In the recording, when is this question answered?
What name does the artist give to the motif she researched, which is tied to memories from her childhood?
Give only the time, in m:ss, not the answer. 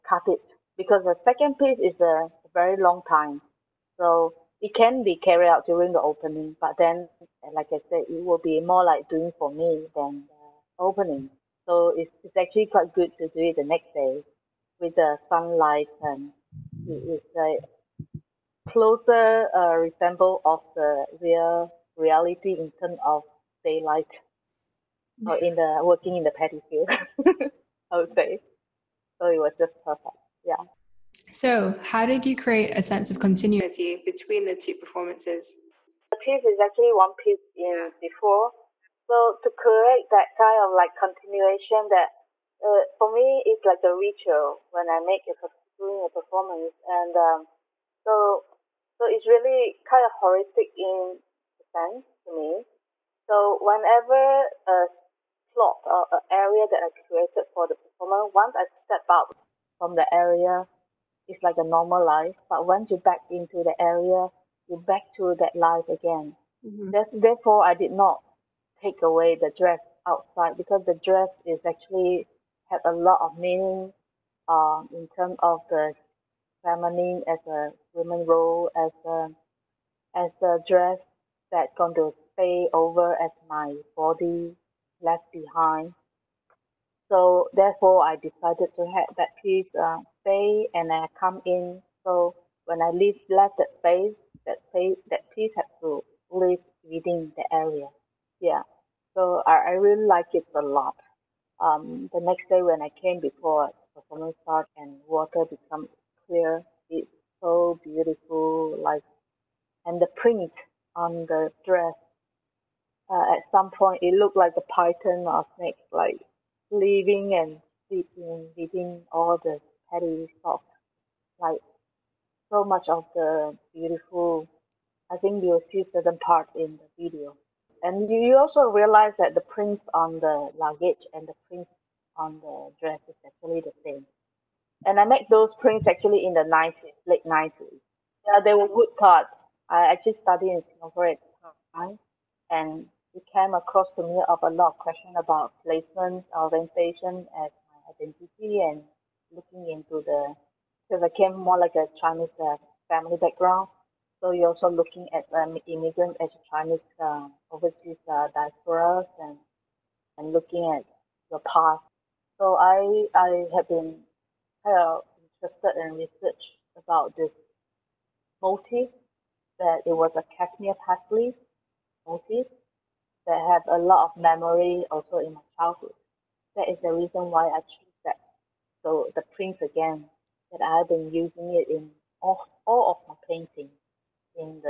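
2:50.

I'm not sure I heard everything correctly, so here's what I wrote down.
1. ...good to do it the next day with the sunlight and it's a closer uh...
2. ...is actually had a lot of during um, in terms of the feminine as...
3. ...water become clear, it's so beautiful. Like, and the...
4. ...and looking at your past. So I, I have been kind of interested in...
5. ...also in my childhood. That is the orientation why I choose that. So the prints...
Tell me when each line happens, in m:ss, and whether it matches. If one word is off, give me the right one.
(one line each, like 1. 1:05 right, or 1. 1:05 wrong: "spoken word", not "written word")
1. 0:12 right
2. 1:11 wrong: "meaning", not "during"
3. 1:45 right
4. 2:40 right
5. 2:54 wrong: "reason", not "orientation".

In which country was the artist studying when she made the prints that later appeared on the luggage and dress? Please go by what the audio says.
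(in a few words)
Singapore.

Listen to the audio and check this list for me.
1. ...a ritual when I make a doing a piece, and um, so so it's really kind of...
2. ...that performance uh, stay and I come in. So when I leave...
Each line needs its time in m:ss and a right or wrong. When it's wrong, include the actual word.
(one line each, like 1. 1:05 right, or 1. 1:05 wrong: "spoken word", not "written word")
1. 0:43 wrong: "performance", not "piece"
2. 1:29 wrong: "piece", not "performance".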